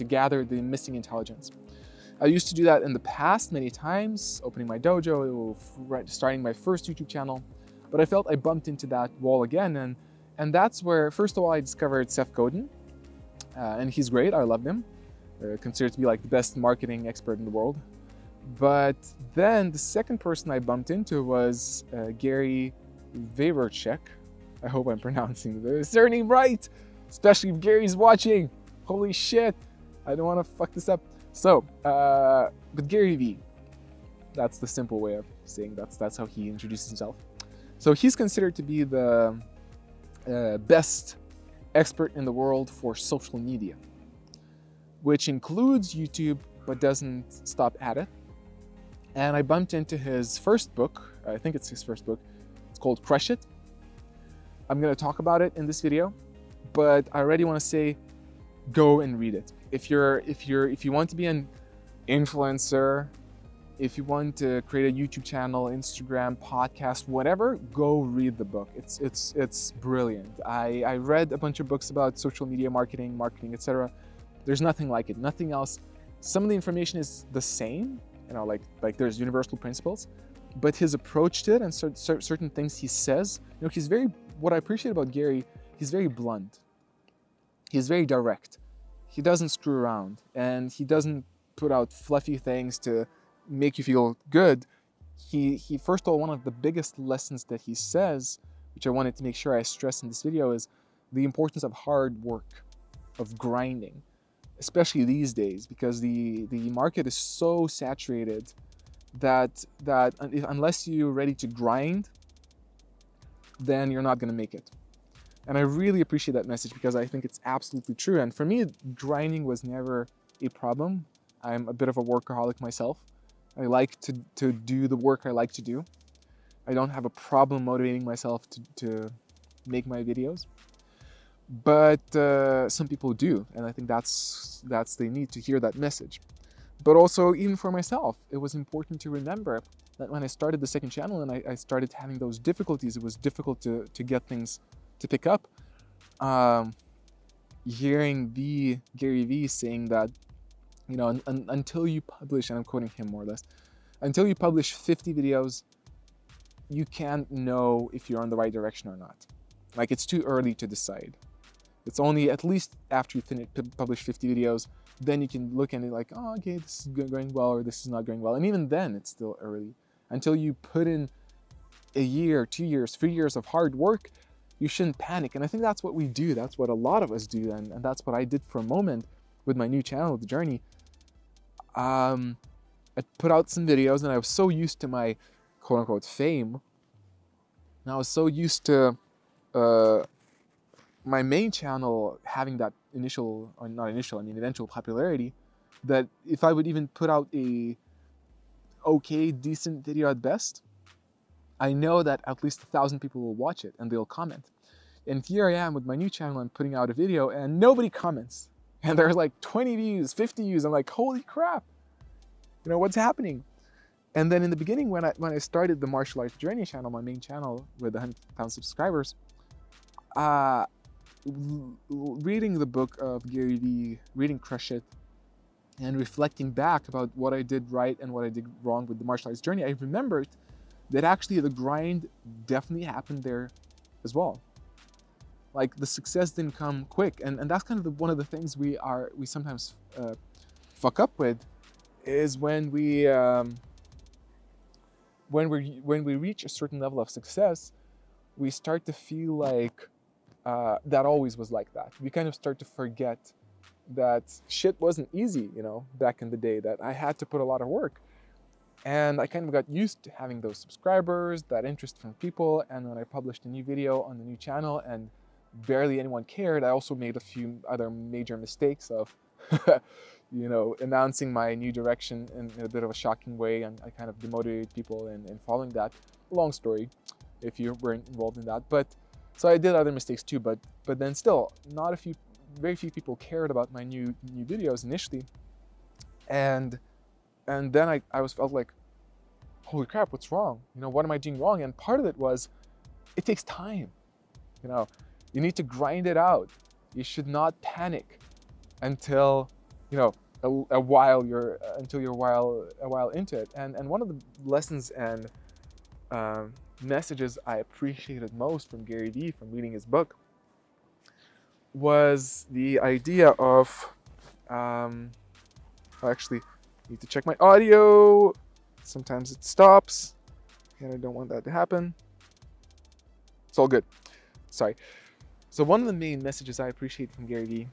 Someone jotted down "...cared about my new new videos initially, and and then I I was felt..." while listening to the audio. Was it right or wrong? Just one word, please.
right.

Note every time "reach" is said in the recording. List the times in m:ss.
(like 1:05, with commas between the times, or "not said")
4:06.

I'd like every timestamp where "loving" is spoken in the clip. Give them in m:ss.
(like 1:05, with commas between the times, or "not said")
not said.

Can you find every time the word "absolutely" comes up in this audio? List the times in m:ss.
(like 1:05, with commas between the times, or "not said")
1:57.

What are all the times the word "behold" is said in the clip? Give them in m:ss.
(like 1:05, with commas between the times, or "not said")
not said.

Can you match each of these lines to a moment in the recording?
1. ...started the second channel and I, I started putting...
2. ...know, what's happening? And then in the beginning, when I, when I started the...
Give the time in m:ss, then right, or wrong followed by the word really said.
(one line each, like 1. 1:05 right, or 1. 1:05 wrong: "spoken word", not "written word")
1. 2:20 wrong: "having", not "putting"
2. 3:32 right.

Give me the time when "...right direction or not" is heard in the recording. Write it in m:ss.
2:38.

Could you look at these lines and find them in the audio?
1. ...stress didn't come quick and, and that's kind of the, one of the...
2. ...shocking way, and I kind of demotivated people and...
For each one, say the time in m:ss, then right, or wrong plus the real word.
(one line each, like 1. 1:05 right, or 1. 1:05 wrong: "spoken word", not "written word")
1. 3:55 wrong: "success", not "stress"
2. 4:32 right.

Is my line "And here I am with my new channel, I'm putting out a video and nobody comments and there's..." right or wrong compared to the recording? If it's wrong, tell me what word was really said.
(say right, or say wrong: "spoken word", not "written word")
right.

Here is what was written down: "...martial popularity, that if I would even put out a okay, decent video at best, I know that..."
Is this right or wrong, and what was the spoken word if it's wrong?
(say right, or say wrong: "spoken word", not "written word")
wrong: "eventual", not "martial".